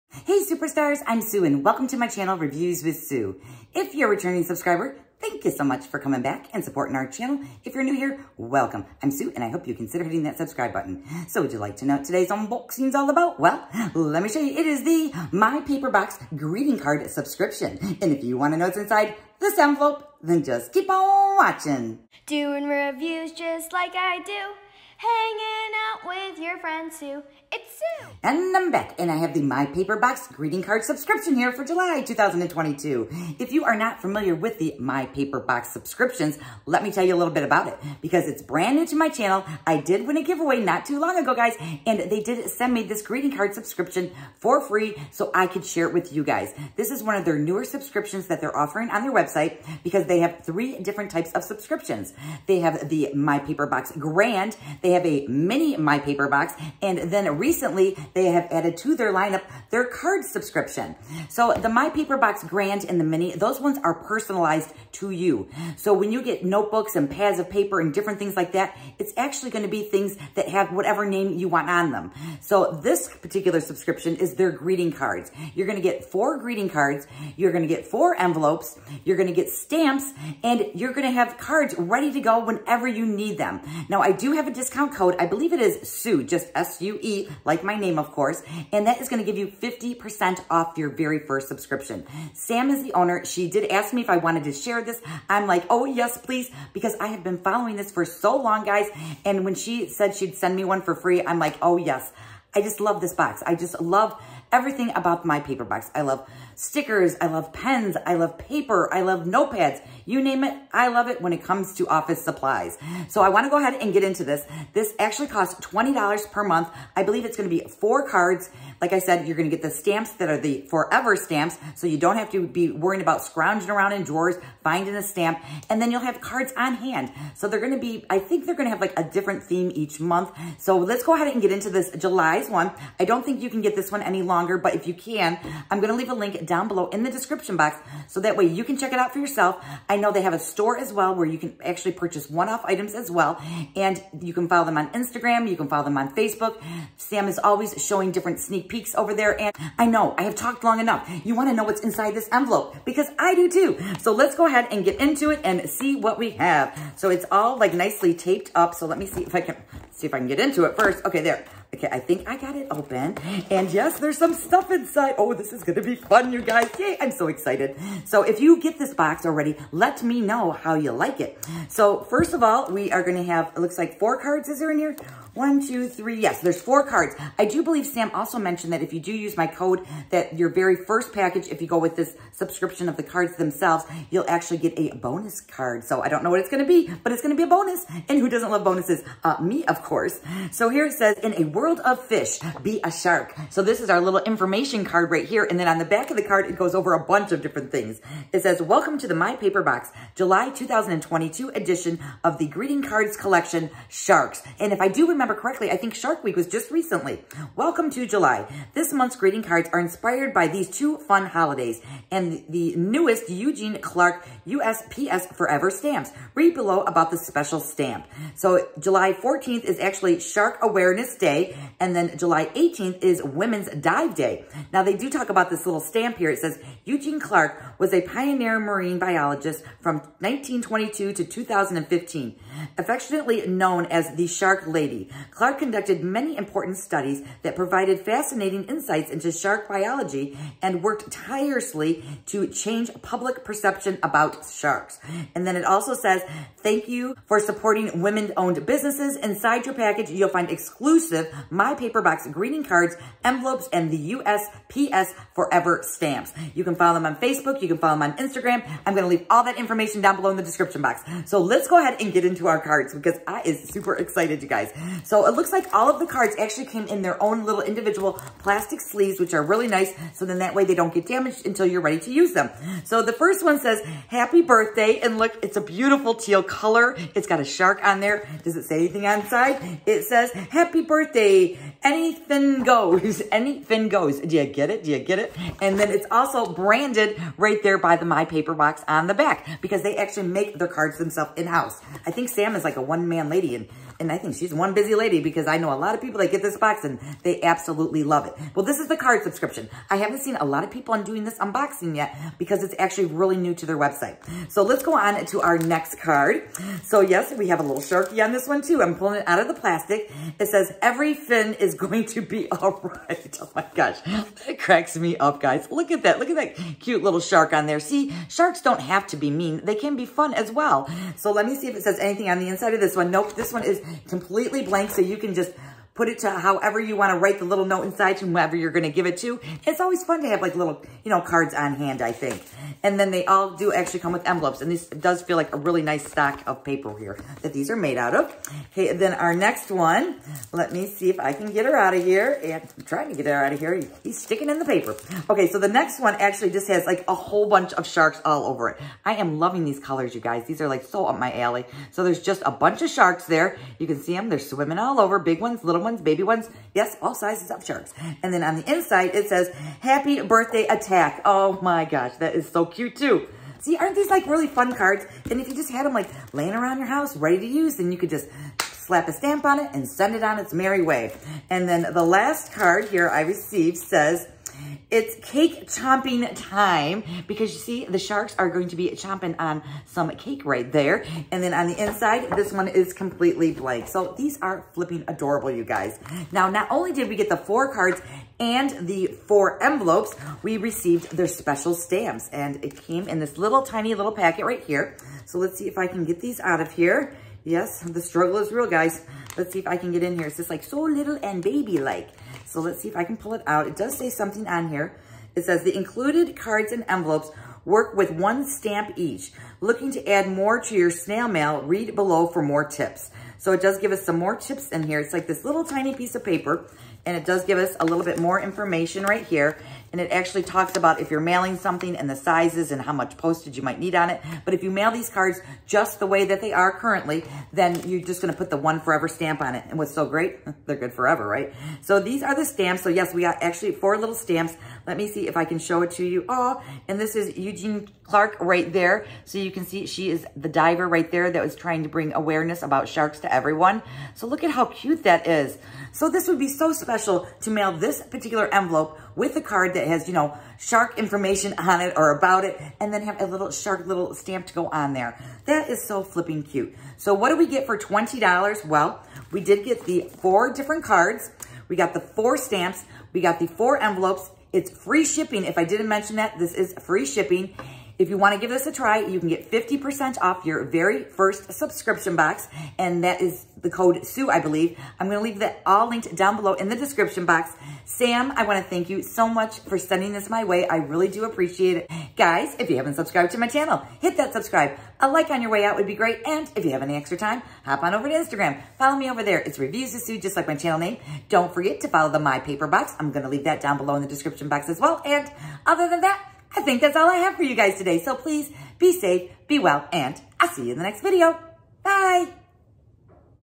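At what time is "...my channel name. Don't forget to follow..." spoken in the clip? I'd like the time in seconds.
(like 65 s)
490 s.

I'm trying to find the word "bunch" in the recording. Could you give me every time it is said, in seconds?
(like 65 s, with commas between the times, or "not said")
197 s, 347 s, 352 s.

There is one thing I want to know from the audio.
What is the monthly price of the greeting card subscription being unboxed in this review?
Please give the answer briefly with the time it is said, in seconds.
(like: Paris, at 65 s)
$20, at 115 s.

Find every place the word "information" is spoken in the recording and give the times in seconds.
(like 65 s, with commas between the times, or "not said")
194 s, 259 s, 418 s, 450 s.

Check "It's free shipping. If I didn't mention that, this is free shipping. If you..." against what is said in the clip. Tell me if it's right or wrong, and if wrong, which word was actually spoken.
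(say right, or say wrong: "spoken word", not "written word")
right.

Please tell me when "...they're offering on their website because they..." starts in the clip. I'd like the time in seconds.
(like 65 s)
48 s.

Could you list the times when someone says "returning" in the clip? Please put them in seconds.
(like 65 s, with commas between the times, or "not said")
4 s.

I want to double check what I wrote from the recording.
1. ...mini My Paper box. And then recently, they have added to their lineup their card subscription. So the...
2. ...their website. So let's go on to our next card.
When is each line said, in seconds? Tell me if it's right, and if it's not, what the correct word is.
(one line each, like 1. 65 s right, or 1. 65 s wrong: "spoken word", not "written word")
1. 55 s right
2. 303 s right.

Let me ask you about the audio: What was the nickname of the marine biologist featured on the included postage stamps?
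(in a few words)
the Shark Lady.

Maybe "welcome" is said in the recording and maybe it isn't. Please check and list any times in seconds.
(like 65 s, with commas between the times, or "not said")
1 s, 8 s, 198 s, 207 s.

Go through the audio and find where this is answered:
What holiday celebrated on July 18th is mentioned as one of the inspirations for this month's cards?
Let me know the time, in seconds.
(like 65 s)
223 s.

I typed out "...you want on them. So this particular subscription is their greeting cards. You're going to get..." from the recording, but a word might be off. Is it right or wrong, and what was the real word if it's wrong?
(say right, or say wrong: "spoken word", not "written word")
right.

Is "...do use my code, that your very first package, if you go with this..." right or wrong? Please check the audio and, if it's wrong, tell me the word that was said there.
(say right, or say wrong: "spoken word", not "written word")
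right.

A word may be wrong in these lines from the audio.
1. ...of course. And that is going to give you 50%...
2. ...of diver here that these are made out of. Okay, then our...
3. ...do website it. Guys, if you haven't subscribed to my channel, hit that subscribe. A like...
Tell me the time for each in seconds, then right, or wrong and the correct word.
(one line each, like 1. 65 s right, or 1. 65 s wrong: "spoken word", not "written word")
1. 87 s right
2. 336 s wrong: "paper", not "diver"
3. 481 s wrong: "appreciate", not "website".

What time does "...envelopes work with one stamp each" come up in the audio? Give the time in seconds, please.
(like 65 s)
406 s.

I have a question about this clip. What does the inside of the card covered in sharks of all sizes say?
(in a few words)
Happy birthday attack.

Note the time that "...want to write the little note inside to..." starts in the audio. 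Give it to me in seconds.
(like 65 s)
326 s.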